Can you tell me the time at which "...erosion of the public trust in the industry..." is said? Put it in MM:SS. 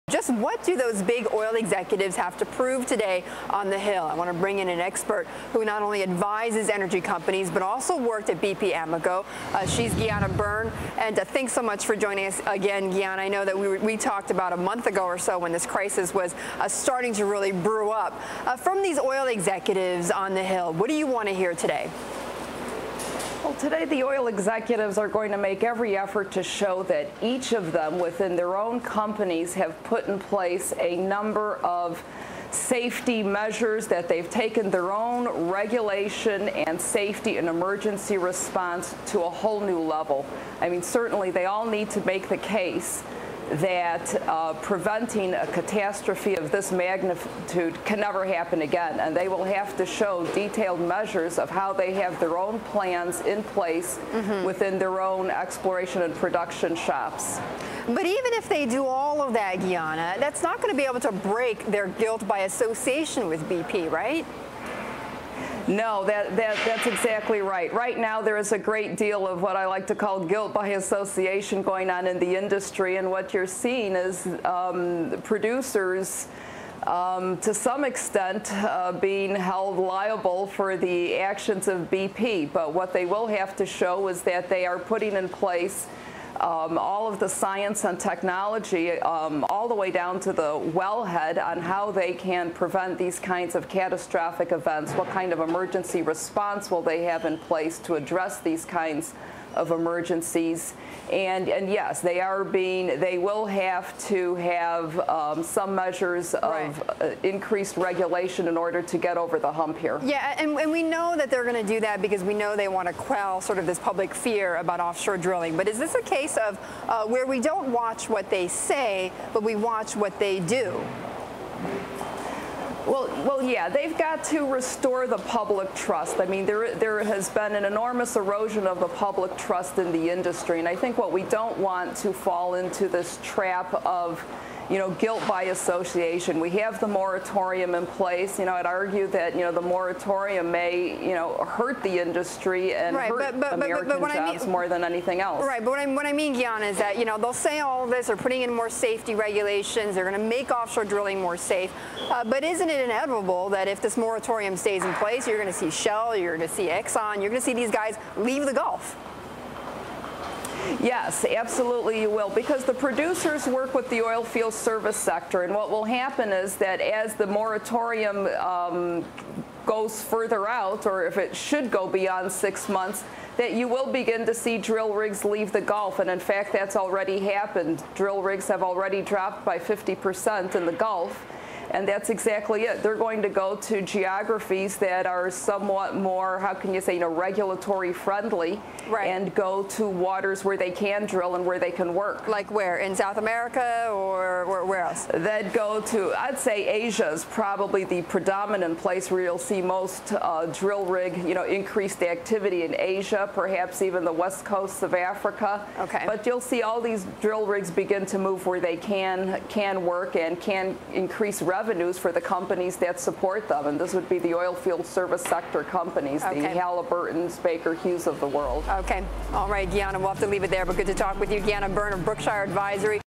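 02:08.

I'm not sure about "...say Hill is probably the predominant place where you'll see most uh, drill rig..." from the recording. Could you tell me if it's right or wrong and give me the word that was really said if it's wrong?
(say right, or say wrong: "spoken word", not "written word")
wrong: "Asia", not "Hill".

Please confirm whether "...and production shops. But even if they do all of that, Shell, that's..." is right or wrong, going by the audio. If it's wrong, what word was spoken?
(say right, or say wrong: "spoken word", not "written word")
wrong: "Gianna", not "Shell".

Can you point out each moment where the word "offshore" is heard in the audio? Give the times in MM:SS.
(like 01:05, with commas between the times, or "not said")
01:54, 02:30.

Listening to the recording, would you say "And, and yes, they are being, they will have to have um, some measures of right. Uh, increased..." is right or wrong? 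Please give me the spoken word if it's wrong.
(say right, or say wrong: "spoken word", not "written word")
right.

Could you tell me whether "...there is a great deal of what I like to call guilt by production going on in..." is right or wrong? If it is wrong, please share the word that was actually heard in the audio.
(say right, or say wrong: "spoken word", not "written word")
wrong: "association", not "production".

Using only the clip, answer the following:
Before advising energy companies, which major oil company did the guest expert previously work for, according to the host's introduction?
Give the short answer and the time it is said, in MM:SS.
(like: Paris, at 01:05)
BP Amoco, at 00:08.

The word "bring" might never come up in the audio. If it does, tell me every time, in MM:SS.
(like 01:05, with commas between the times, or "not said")
00:04.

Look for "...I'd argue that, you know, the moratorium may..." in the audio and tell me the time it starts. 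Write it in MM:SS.
02:18.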